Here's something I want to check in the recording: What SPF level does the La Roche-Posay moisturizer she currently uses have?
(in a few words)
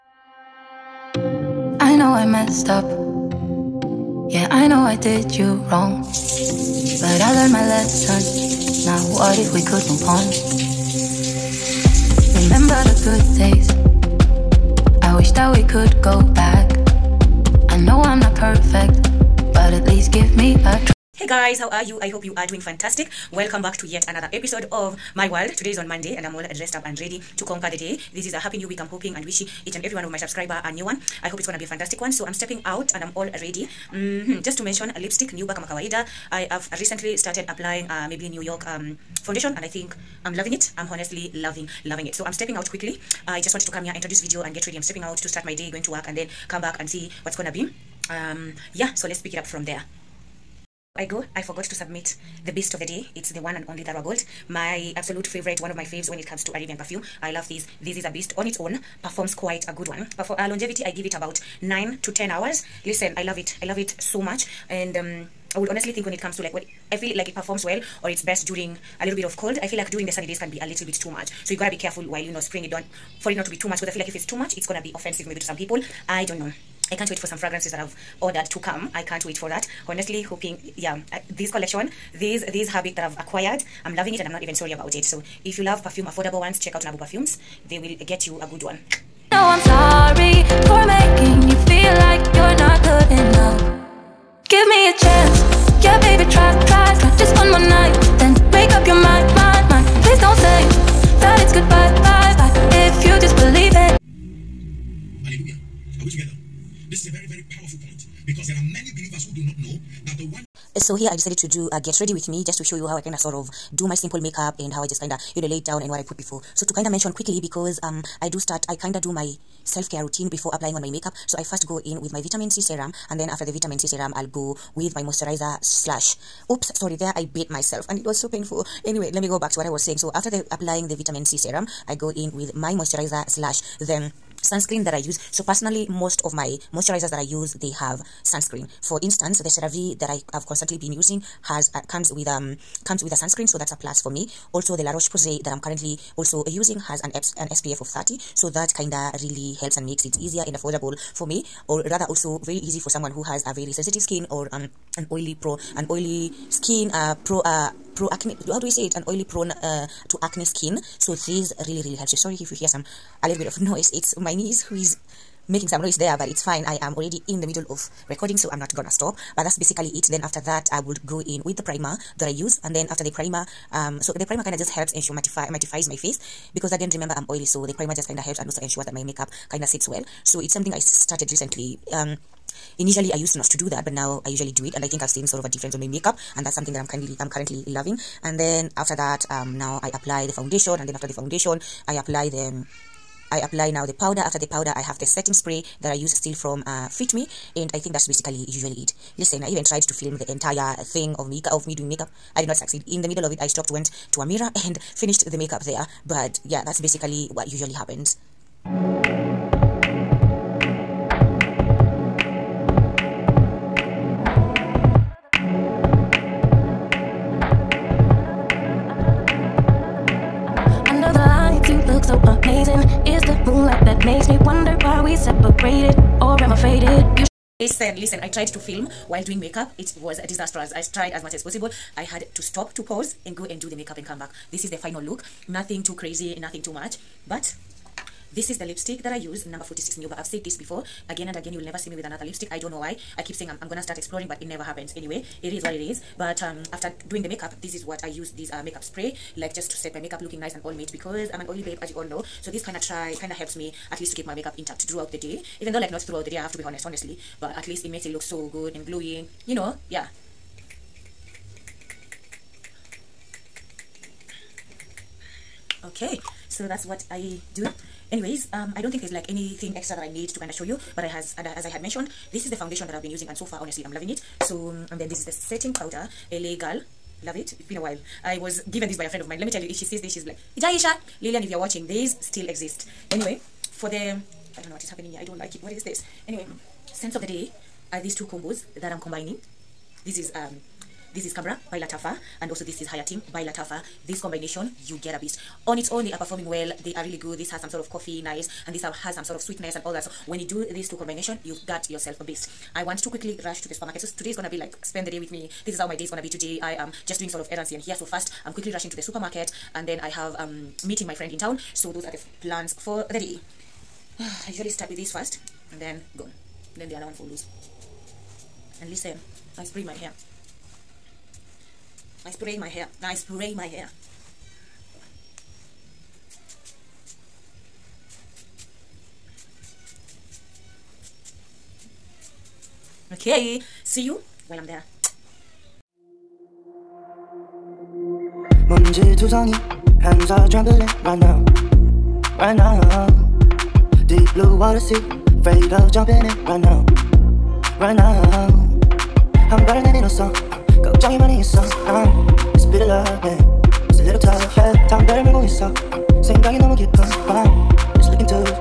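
30.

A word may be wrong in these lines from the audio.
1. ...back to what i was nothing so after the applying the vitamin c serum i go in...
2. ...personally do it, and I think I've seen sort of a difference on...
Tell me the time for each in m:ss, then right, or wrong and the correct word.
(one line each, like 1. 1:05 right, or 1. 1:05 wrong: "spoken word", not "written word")
1. 2:09 wrong: "saying", not "nothing"
2. 3:04 wrong: "usually", not "personally".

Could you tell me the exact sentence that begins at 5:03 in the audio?
So today is gonna be like spend the day with me.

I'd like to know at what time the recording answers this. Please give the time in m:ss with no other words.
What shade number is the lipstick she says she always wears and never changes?
3:59.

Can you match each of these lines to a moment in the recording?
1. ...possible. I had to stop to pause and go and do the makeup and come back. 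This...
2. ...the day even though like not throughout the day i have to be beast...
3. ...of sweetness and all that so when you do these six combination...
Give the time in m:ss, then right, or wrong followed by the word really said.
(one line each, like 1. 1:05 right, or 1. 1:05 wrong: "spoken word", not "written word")
1. 3:51 right
2. 4:15 wrong: "honest", not "beast"
3. 4:59 wrong: "two", not "six".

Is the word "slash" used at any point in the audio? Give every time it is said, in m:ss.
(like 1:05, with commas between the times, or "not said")
2:05, 2:13.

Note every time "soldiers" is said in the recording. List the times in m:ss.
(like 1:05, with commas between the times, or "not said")
not said.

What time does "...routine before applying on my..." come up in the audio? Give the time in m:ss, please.
2:00.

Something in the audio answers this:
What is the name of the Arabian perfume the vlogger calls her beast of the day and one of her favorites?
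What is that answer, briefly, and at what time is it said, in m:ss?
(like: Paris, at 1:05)
Darwa Gold, at 0:53.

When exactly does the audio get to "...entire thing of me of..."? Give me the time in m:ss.
3:20.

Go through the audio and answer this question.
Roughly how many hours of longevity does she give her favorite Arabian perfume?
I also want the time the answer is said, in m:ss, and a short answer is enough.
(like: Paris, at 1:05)
9 to 10 hours, at 1:01.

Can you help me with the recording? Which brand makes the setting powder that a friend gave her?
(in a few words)
LA Girl.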